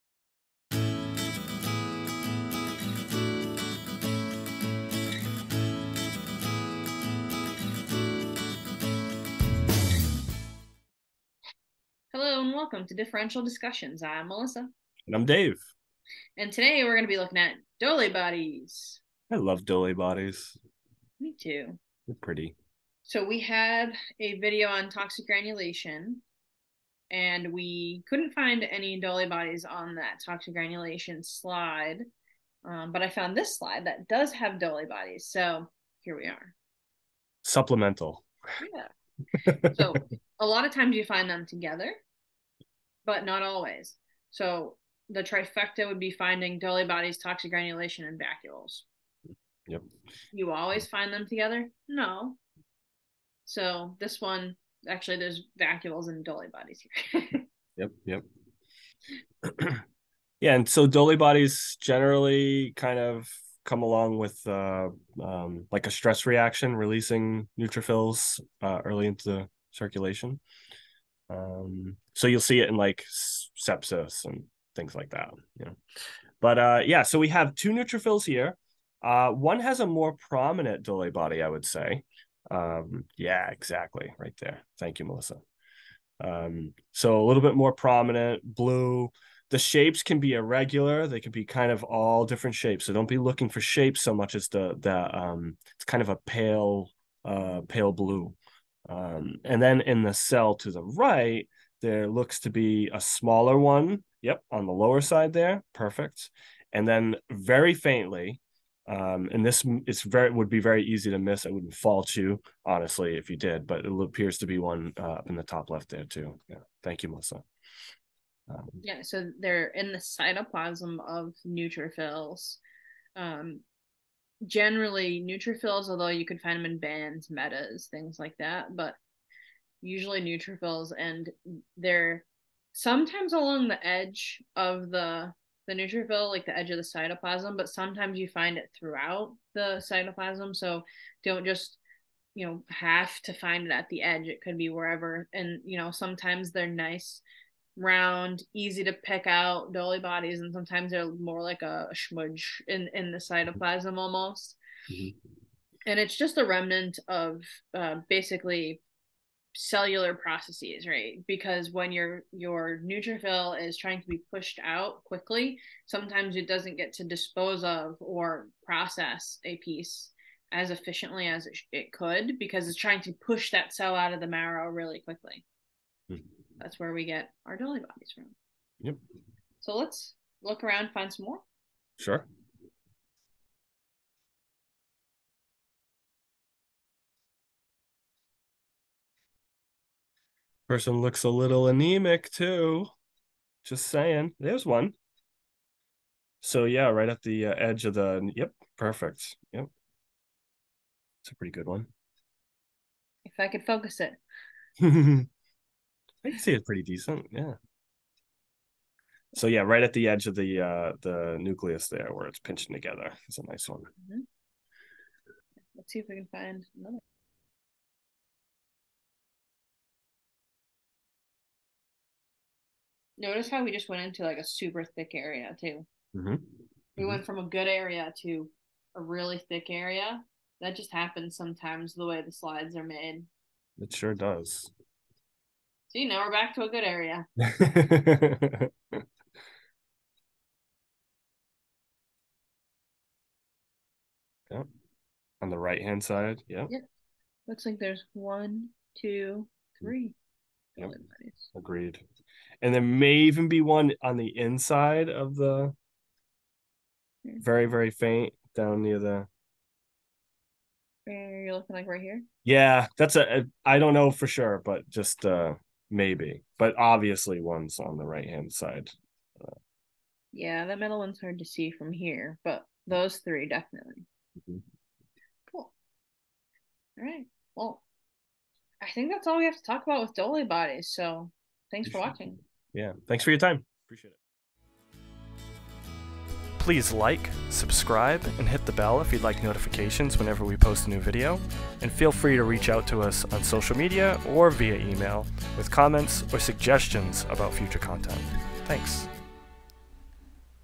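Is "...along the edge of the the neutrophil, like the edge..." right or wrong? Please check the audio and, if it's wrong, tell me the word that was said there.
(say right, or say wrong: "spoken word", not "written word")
right.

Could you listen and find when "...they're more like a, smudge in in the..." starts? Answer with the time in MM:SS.
02:30.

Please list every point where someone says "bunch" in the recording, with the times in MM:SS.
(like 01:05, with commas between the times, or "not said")
not said.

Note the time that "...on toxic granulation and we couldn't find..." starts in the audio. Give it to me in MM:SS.
00:24.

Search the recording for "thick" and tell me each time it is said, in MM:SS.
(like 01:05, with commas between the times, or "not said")
03:44, 03:49.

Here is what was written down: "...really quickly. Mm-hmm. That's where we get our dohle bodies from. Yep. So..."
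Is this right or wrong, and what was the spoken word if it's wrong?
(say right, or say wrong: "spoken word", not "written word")
right.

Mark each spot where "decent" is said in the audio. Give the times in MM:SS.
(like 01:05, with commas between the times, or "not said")
03:26.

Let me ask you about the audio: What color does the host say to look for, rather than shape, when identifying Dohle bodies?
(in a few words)
Pale blue.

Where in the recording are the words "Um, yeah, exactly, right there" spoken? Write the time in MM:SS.
01:22.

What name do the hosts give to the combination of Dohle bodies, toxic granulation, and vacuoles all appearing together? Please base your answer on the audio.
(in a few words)
The trifecta.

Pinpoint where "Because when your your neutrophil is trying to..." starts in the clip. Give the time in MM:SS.
02:41.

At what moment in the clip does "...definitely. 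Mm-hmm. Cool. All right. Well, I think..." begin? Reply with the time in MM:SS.
04:33.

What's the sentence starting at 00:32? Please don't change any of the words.
Um, but I found this slide that does have Dohle bodies.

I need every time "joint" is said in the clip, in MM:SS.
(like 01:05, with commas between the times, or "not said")
not said.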